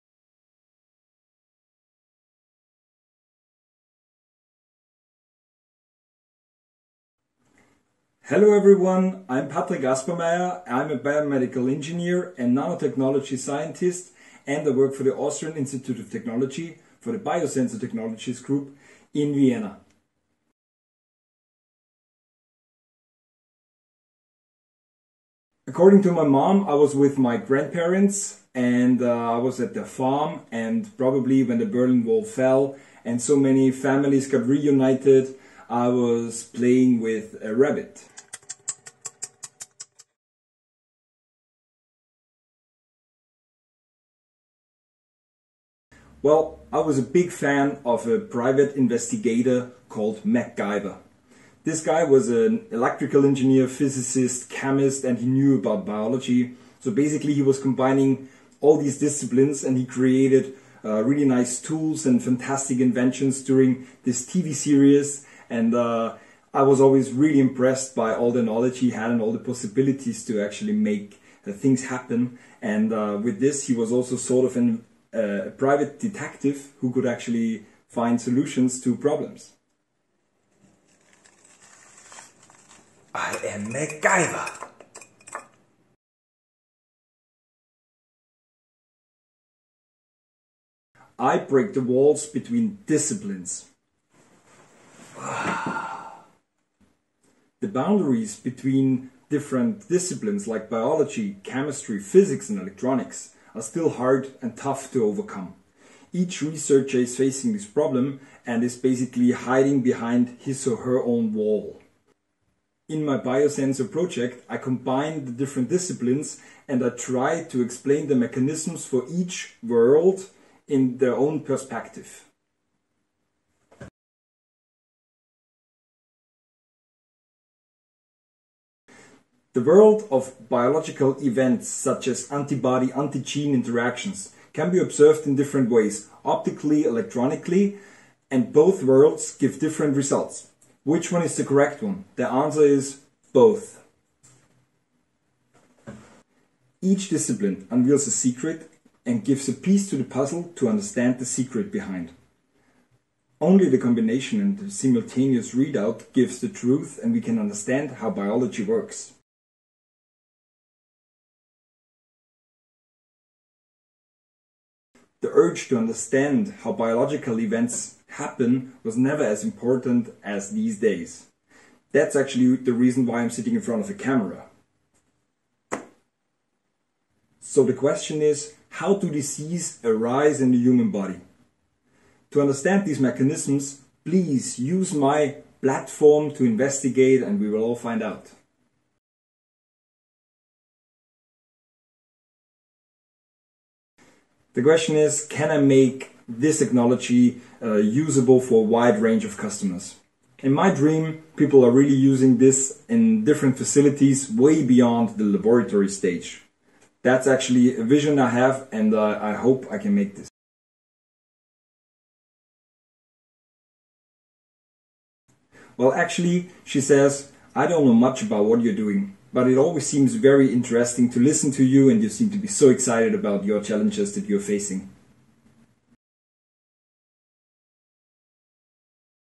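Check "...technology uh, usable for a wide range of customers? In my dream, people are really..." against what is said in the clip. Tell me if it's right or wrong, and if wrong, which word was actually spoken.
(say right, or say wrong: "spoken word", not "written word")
right.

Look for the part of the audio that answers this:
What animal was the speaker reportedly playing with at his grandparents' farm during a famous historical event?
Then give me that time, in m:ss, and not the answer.
0:37.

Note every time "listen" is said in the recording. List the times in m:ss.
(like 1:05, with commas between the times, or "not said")
3:41.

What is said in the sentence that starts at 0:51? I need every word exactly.
This guy was an electrical engineer, physicist, chemist, and he knew about biology.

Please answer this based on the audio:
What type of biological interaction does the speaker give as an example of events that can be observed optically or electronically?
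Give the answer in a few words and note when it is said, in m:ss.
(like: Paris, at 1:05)
Antibody-antigen interactions, at 2:12.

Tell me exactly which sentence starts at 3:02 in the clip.
To understand these mechanisms, please use my platform to investigate and we will all find out.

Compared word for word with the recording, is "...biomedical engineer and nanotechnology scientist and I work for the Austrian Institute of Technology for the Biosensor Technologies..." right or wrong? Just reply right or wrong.
right.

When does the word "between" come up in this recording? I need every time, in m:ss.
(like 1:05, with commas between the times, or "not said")
1:32, 1:38.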